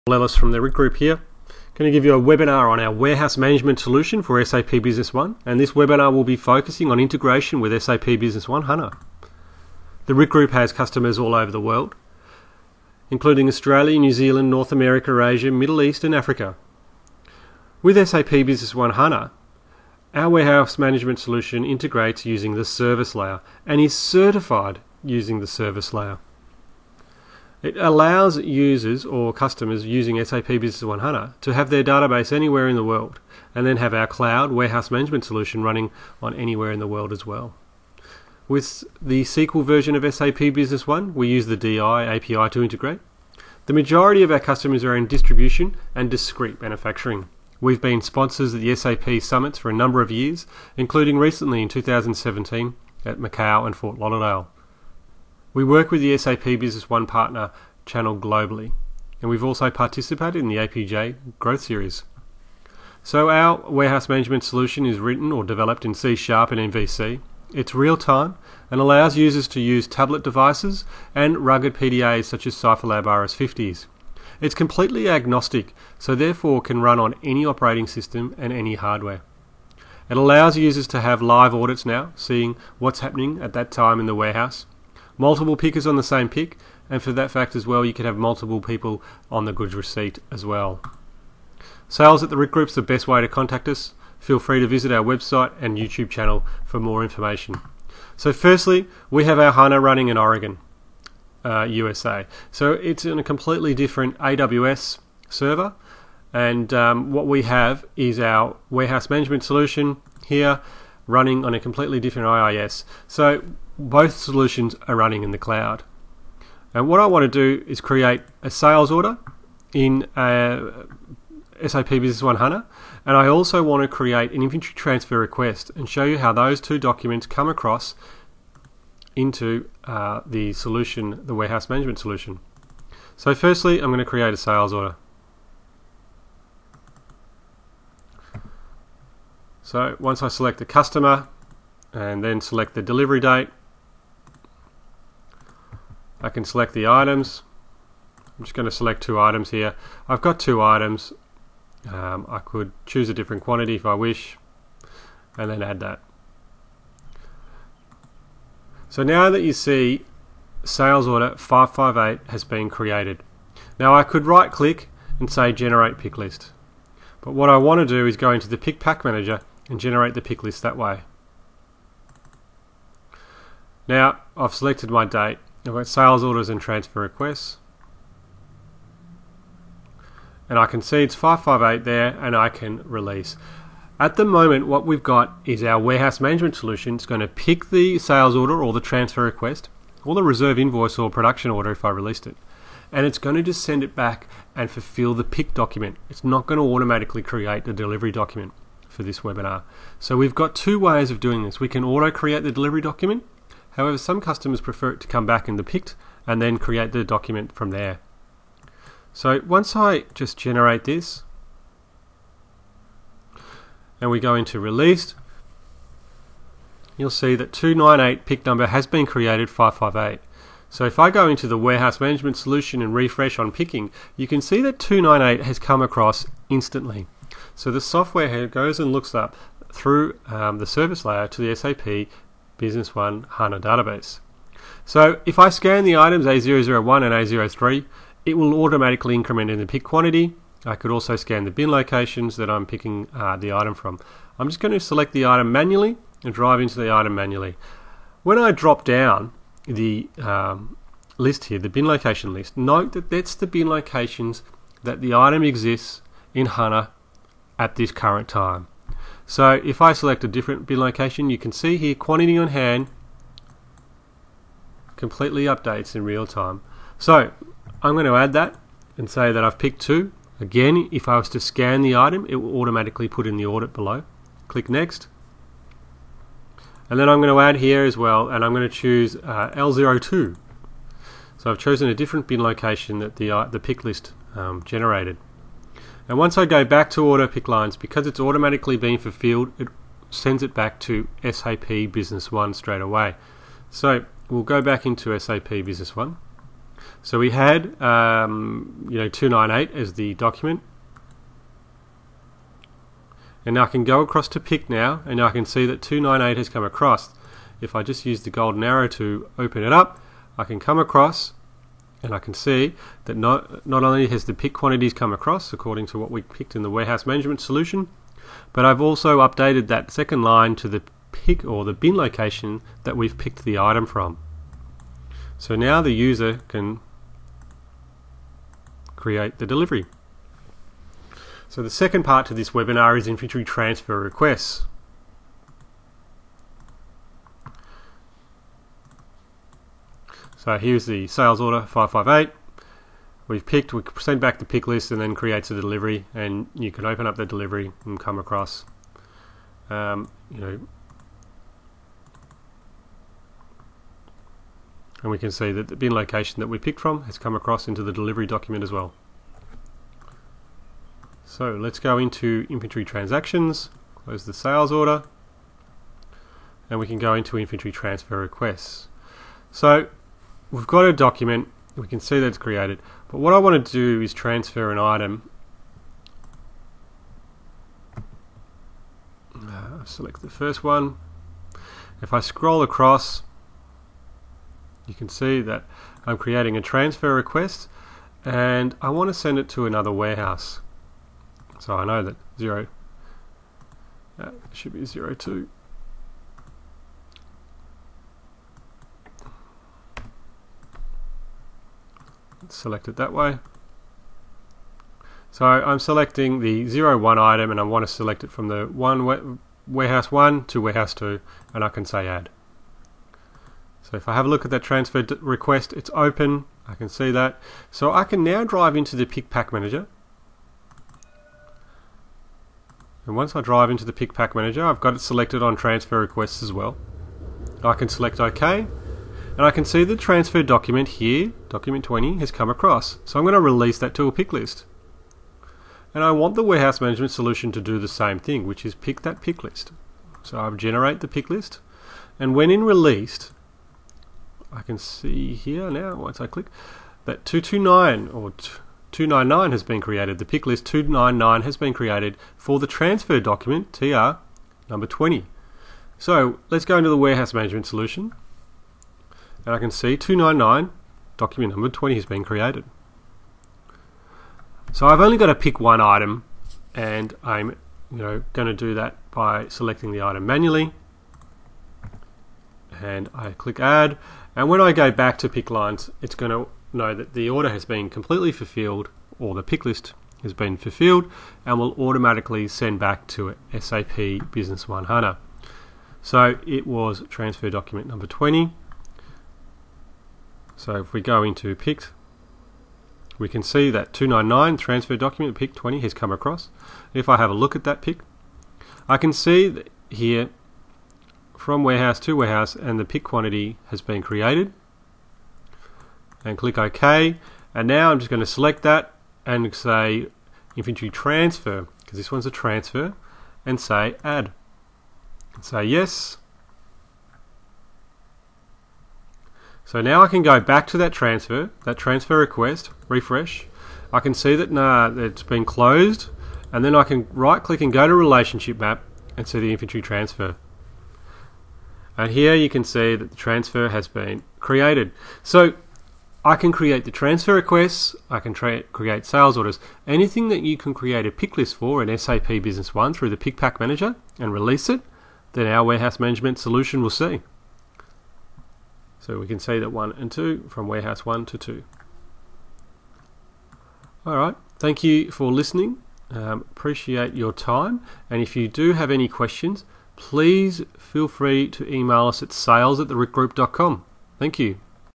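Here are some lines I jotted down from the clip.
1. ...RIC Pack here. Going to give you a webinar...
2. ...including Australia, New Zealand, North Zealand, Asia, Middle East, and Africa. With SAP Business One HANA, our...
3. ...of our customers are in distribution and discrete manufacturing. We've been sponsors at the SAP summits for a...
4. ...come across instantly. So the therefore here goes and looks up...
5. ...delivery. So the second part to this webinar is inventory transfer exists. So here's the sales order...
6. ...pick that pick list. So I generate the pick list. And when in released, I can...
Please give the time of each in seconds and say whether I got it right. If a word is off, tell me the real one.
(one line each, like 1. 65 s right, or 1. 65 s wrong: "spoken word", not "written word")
1. 0 s wrong: "Group", not "Pack"
2. 13 s wrong: "America", not "Zealand"
3. 44 s right
4. 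225 s wrong: "software", not "therefore"
5. 329 s wrong: "requests", not "exists"
6. 438 s right.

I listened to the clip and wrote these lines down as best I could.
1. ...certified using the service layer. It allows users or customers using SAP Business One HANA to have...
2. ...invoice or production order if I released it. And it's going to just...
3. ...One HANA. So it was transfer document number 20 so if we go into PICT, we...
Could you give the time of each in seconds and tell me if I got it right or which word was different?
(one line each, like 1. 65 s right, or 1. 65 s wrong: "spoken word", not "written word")
1. 23 s right
2. 190 s right
3. 484 s right.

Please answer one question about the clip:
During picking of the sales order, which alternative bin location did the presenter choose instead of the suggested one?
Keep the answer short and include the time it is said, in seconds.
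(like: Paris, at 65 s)
L02, at 279 s.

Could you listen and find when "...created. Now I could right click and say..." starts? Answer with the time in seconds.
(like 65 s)
162 s.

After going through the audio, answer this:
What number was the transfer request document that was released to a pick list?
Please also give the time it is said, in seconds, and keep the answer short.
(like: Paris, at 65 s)
20, at 431 s.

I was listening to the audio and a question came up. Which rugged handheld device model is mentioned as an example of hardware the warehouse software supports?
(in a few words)
CipherLab RS50.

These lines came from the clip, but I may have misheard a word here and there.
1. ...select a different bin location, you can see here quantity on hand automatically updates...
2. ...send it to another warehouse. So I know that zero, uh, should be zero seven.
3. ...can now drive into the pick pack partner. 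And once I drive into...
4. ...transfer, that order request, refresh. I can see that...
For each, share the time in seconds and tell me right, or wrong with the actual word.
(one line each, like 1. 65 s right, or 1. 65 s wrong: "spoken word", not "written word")
1. 259 s wrong: "completely", not "automatically"
2. 389 s wrong: "two", not "seven"
3. 418 s wrong: "manager", not "partner"
4. 520 s wrong: "transfer", not "order".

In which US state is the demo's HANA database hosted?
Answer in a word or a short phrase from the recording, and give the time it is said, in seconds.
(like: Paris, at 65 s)
Oregon, at 100 s.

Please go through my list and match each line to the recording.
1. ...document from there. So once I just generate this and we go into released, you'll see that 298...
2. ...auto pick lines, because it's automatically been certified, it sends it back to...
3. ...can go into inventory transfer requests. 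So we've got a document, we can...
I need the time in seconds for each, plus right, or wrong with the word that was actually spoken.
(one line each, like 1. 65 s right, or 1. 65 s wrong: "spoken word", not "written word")
1. 207 s right
2. 287 s wrong: "fulfilled", not "certified"
3. 366 s right.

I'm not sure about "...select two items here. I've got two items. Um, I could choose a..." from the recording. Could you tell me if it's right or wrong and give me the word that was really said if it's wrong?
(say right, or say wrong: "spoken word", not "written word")
right.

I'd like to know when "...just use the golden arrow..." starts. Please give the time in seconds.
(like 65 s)
307 s.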